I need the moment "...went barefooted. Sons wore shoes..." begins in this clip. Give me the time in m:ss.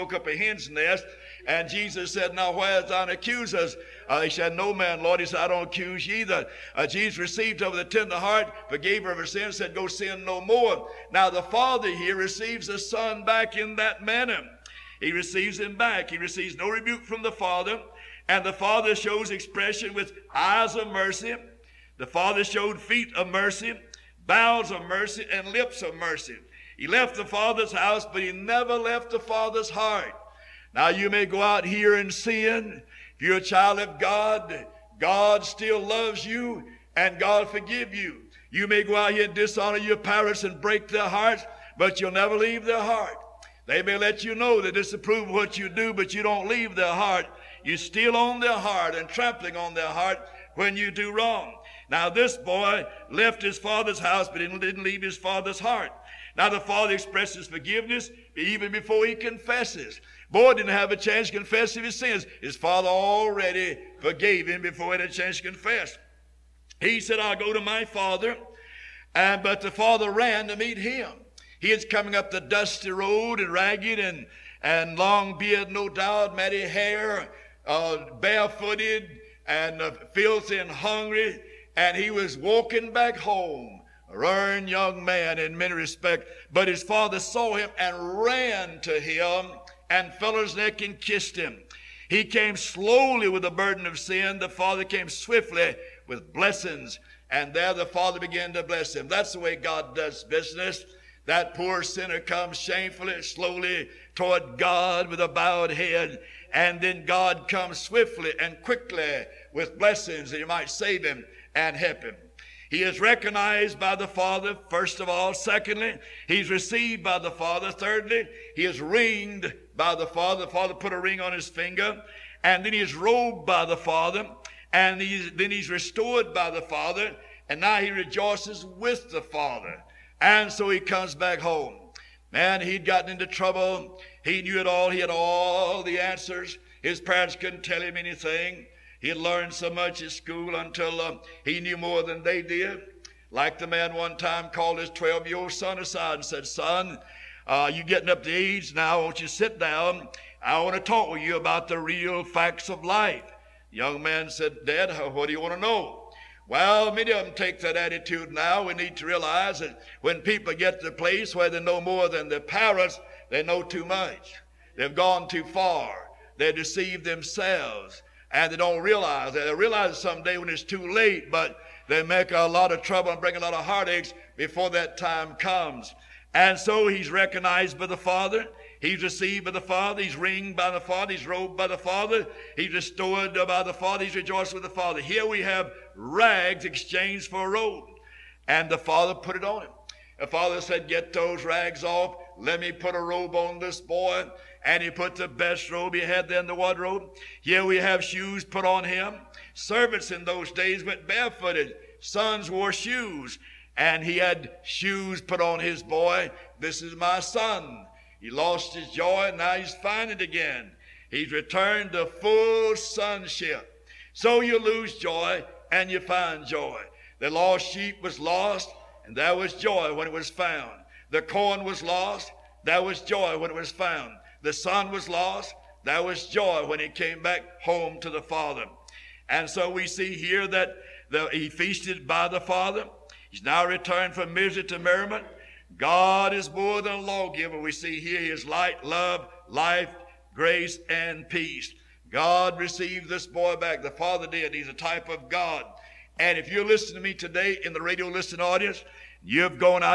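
3:20.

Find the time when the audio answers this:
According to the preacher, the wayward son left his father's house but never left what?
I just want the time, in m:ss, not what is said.
0:29.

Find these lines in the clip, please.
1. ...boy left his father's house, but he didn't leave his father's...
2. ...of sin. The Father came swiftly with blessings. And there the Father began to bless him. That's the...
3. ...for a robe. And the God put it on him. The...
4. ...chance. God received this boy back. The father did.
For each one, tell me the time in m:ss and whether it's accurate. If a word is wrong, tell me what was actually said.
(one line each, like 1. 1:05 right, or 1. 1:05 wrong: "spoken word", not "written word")
1. 0:52 right
2. 1:33 right
3. 3:07 wrong: "Father", not "God"
4. 4:01 wrong: "peace", not "chance".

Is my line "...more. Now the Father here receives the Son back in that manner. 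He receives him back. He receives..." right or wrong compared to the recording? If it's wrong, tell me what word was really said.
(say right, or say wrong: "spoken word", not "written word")
right.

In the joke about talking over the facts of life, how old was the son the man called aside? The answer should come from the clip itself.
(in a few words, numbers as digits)
12.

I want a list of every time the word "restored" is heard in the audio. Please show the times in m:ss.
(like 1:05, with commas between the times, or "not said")
2:05, 3:02.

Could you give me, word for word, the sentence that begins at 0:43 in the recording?
They may let you know they disapprove of what you do, but you don't leave their heart.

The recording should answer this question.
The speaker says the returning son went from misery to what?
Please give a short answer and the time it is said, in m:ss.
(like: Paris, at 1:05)
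Merriment, at 3:54.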